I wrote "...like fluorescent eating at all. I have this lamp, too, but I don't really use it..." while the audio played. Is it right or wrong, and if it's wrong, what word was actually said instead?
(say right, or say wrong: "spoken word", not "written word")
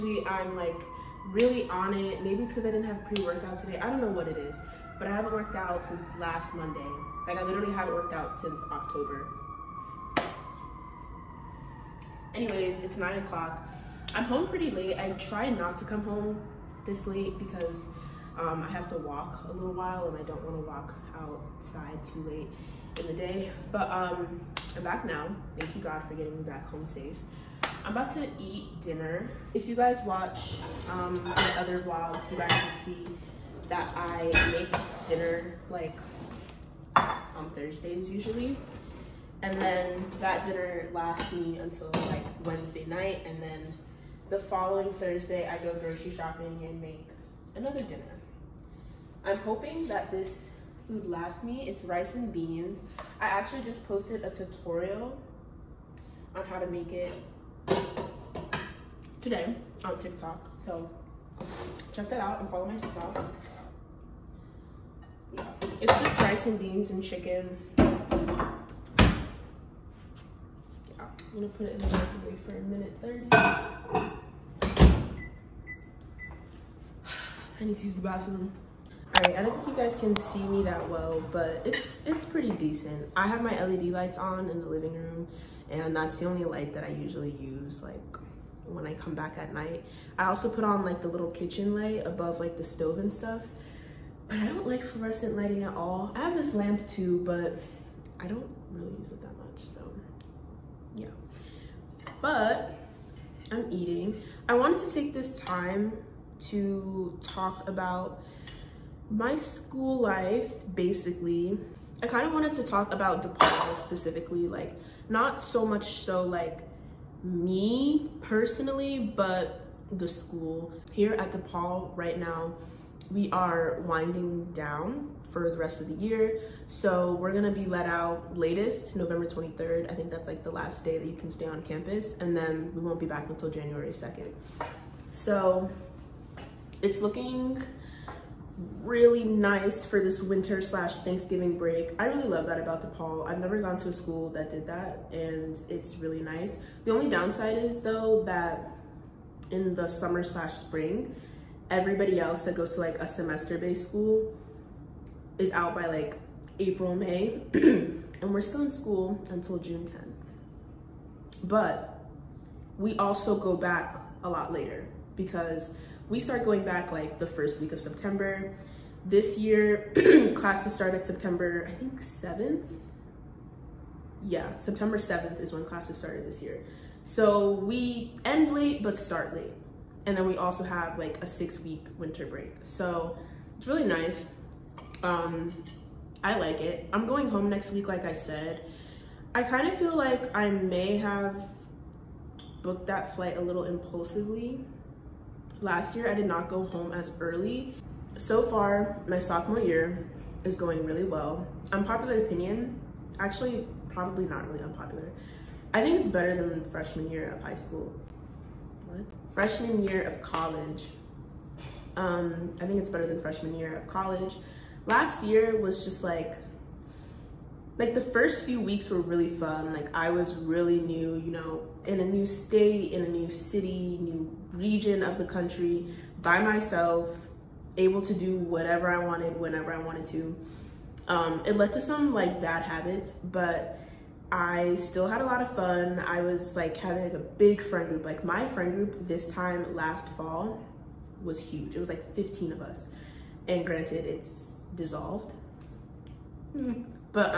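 wrong: "lighting", not "eating".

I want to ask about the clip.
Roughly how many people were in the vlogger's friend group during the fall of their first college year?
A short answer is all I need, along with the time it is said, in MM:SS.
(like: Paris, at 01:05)
15, at 04:02.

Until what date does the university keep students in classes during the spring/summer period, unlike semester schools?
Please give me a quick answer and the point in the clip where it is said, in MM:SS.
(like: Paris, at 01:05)
June 10th, at 02:39.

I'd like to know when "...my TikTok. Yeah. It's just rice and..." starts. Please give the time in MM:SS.
01:02.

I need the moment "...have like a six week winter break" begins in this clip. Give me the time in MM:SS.
03:00.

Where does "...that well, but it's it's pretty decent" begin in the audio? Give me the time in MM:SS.
01:20.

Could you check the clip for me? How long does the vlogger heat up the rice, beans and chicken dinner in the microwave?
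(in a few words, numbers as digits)
1 minute 30.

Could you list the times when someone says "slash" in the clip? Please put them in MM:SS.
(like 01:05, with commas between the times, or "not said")
02:20, 02:30.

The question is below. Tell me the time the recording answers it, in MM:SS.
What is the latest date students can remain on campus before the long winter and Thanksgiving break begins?
02:08.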